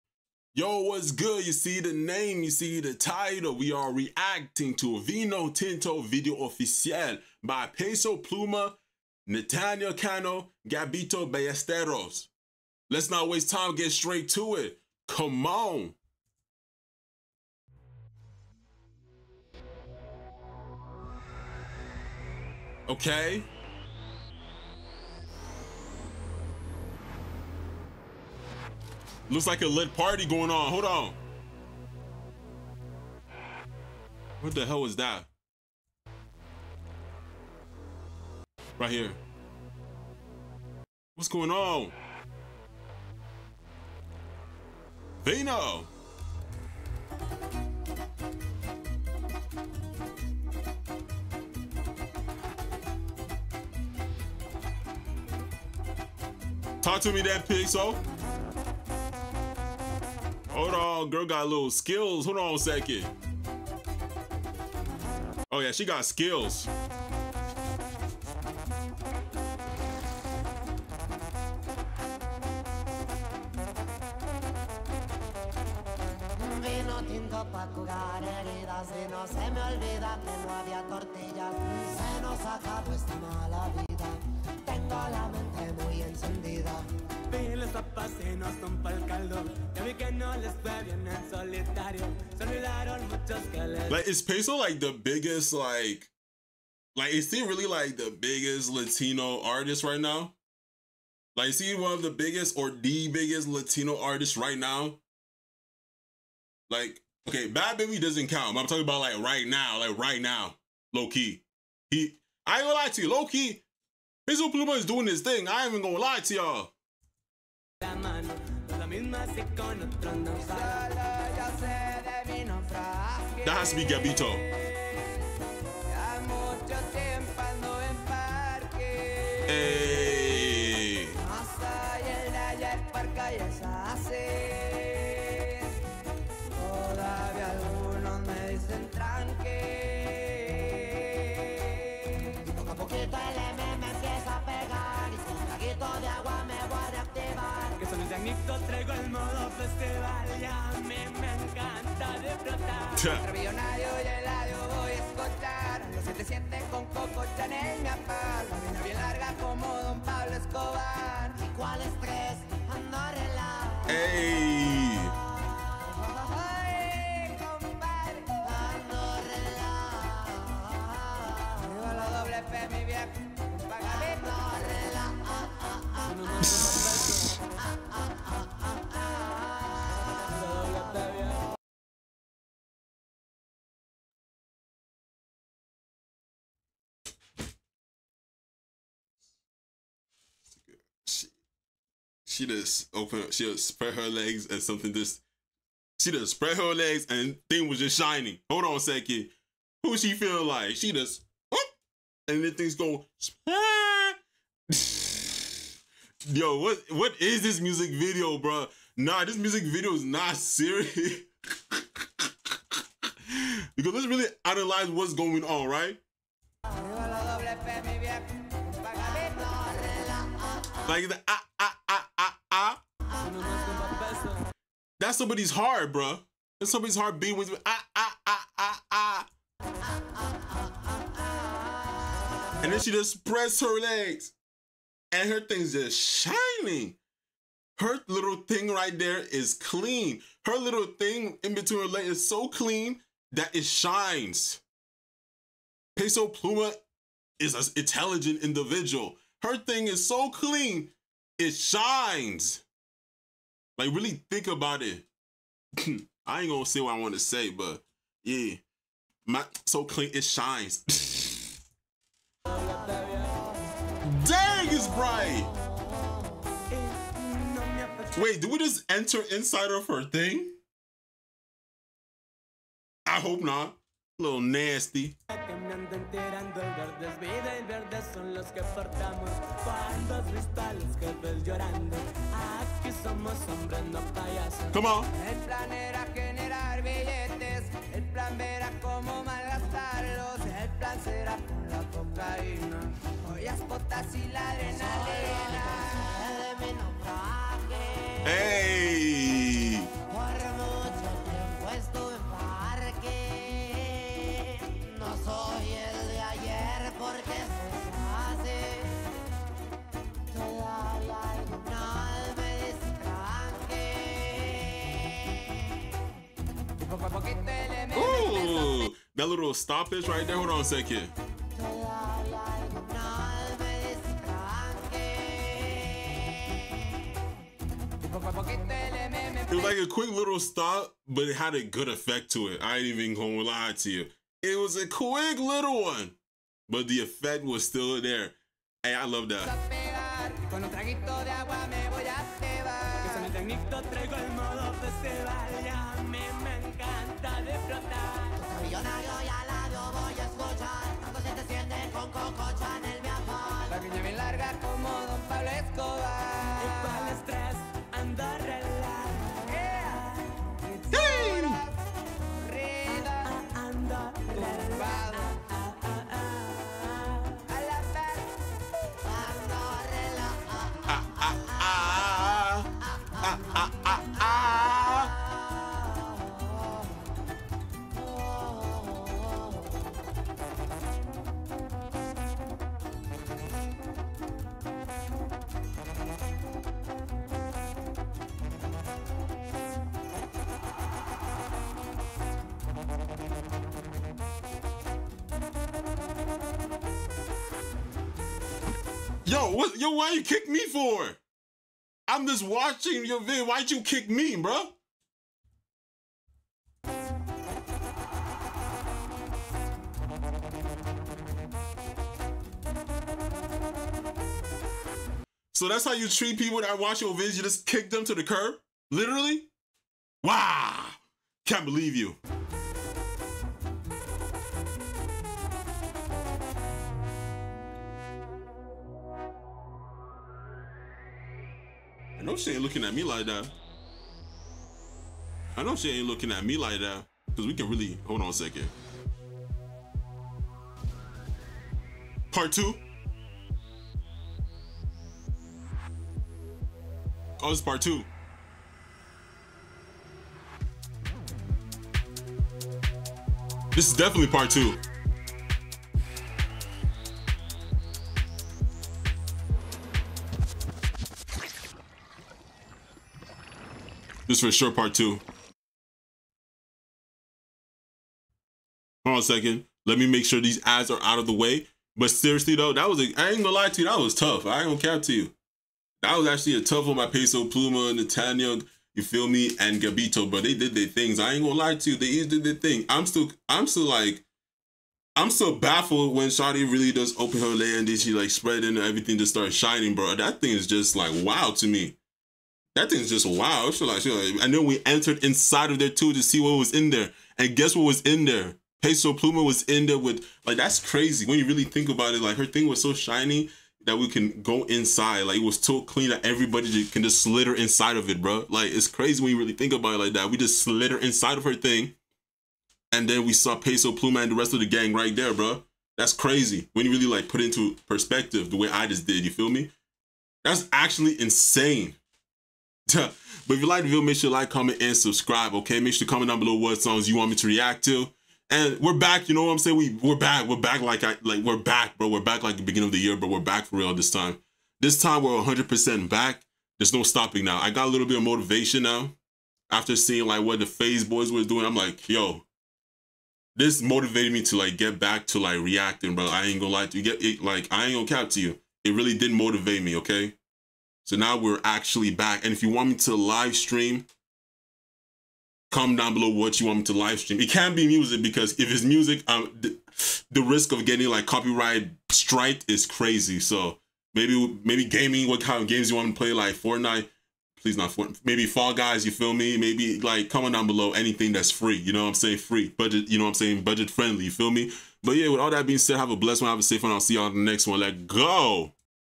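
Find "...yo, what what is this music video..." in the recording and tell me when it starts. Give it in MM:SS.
03:26.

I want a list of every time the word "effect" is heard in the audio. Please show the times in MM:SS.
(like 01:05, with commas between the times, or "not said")
05:31, 05:37.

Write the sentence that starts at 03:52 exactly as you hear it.
And then she just spreads her legs.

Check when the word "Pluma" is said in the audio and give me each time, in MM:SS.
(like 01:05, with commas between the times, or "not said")
00:08, 01:54, 04:06, 07:57, 08:19, 08:33.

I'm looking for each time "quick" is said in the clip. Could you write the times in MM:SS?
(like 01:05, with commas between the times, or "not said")
05:29, 05:34.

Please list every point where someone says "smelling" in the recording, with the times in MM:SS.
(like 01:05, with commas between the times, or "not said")
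not said.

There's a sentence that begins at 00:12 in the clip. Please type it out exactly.
Let's not waste time, get straight to it.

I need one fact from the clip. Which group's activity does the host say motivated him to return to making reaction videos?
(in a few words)
Phase Boys.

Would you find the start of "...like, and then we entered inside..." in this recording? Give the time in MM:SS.
08:14.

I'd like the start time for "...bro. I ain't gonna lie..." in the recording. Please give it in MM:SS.
09:06.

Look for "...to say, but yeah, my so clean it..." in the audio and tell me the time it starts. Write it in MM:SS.
04:17.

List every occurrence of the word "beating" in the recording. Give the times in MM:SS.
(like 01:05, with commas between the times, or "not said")
03:47.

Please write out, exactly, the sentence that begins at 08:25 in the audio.
Like it was so clean that everybody can just slither inside of it, bro.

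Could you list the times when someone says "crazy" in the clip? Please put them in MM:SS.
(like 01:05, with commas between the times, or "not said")
08:20, 08:28, 08:36, 09:22.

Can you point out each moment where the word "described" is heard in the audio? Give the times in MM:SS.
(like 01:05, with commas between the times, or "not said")
not said.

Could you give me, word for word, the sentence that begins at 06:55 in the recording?
So that's how you treat people that watch your videos.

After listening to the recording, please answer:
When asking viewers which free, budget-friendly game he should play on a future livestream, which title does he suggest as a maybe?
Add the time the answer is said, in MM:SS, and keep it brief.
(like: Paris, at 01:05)
Fall Guys, at 09:28.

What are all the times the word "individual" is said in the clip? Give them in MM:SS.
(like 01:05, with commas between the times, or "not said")
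04:08.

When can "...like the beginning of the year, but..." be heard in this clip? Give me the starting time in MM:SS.
08:52.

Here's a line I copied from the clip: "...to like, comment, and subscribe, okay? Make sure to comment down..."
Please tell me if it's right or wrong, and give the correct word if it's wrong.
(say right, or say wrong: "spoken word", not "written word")
right.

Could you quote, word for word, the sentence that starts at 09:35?
But yeah, with all that being said, have a blessed one, have a safe one.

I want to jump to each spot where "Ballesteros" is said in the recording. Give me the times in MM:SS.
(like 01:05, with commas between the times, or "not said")
00:11.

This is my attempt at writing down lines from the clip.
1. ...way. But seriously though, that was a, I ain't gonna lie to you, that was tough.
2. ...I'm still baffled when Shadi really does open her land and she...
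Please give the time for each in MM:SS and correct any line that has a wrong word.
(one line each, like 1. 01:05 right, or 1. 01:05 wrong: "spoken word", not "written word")
1. 07:51 right
2. 08:05 right.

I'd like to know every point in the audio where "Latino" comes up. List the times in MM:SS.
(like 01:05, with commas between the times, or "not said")
01:38, 01:43.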